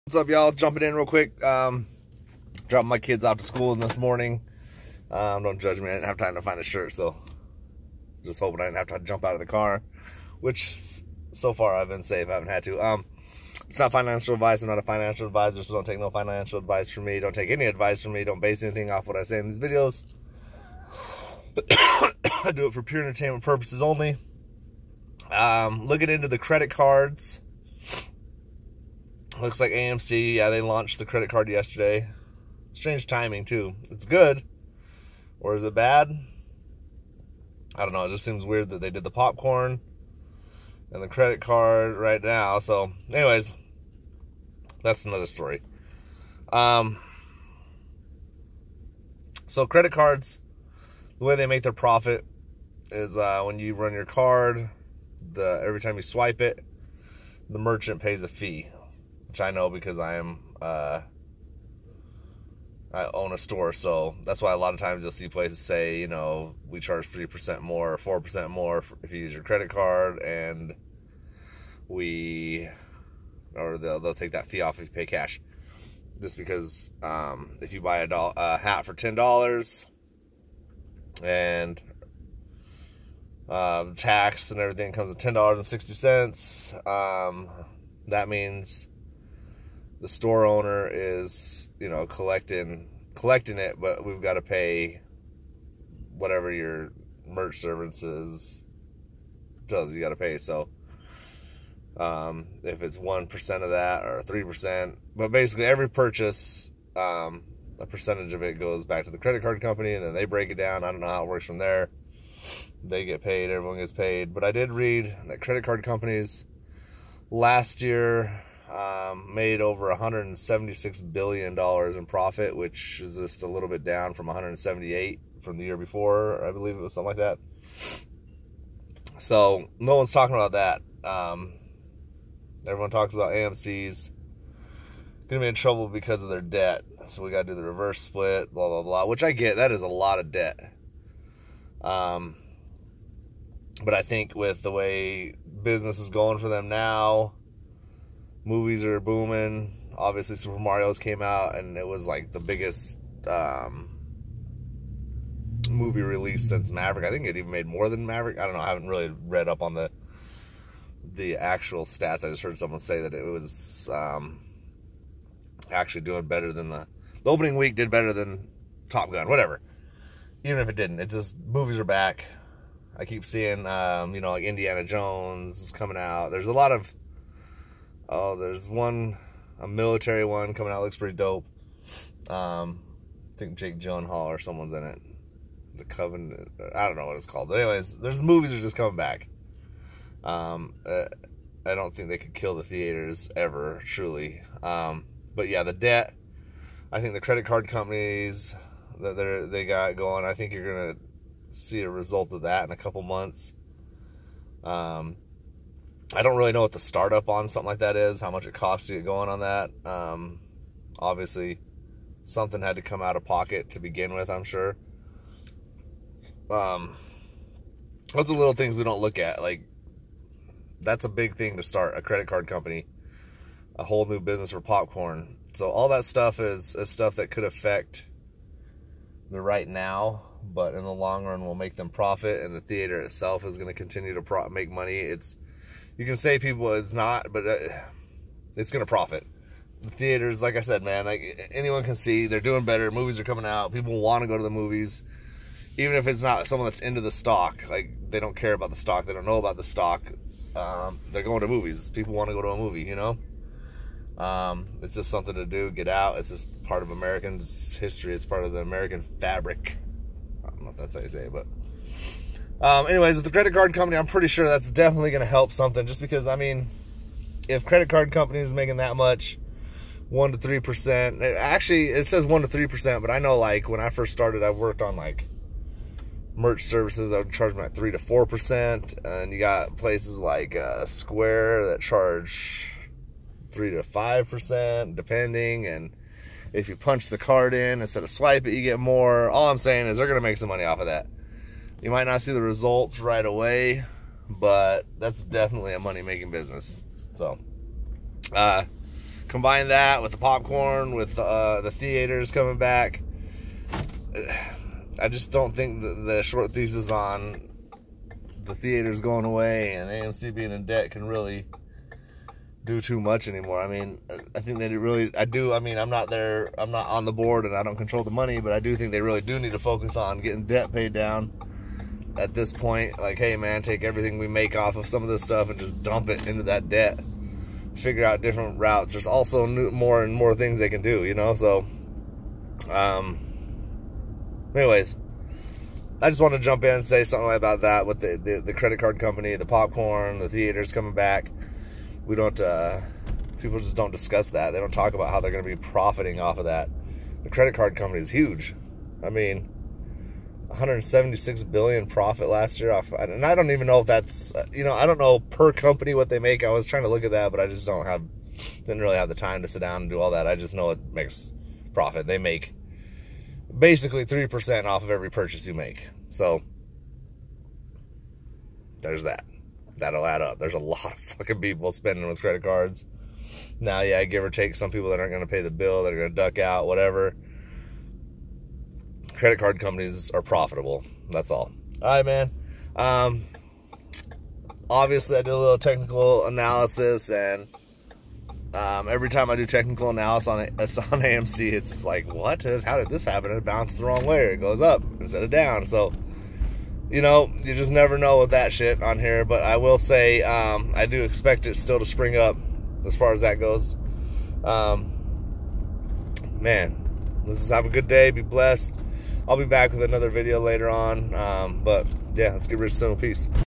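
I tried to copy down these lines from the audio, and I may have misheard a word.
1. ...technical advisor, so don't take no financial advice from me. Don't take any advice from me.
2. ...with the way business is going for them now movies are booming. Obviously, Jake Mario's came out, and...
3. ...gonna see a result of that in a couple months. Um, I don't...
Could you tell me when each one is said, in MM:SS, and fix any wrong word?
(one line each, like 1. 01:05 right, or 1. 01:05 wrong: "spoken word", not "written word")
1. 00:14 wrong: "financial", not "technical"
2. 02:24 wrong: "Super", not "Jake"
3. 03:20 right.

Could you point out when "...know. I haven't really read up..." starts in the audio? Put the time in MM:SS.
02:38.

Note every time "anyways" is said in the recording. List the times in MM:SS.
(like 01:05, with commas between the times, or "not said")
00:43, 03:07, 04:22, 05:34.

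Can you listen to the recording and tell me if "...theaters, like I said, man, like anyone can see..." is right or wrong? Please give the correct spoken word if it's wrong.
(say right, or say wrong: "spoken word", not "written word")
right.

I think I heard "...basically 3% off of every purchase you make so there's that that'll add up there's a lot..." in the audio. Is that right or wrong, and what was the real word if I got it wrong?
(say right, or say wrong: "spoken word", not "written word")
right.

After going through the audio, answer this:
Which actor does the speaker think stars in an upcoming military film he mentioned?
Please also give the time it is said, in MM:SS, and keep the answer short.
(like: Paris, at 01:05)
Jake Gyllenhaal, at 03:03.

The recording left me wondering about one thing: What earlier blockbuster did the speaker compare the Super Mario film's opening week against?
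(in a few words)
Top Gun.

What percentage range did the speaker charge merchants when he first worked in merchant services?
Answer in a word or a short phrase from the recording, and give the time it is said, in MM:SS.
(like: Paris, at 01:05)
3 to 4%, at 04:37.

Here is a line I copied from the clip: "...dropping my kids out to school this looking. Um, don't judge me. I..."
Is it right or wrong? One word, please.
wrong.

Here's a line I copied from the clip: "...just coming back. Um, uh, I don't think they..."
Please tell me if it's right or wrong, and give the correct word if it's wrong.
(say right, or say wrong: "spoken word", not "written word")
right.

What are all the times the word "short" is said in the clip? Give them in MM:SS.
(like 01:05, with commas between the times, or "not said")
05:06.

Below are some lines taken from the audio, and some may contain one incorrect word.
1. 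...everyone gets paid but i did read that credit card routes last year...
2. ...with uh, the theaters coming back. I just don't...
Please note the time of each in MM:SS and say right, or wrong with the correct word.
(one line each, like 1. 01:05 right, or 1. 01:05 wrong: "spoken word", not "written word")
1. 01:53 wrong: "companies", not "routes"
2. 05:00 right.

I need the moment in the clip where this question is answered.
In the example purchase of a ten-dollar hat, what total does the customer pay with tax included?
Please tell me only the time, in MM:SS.
01:25.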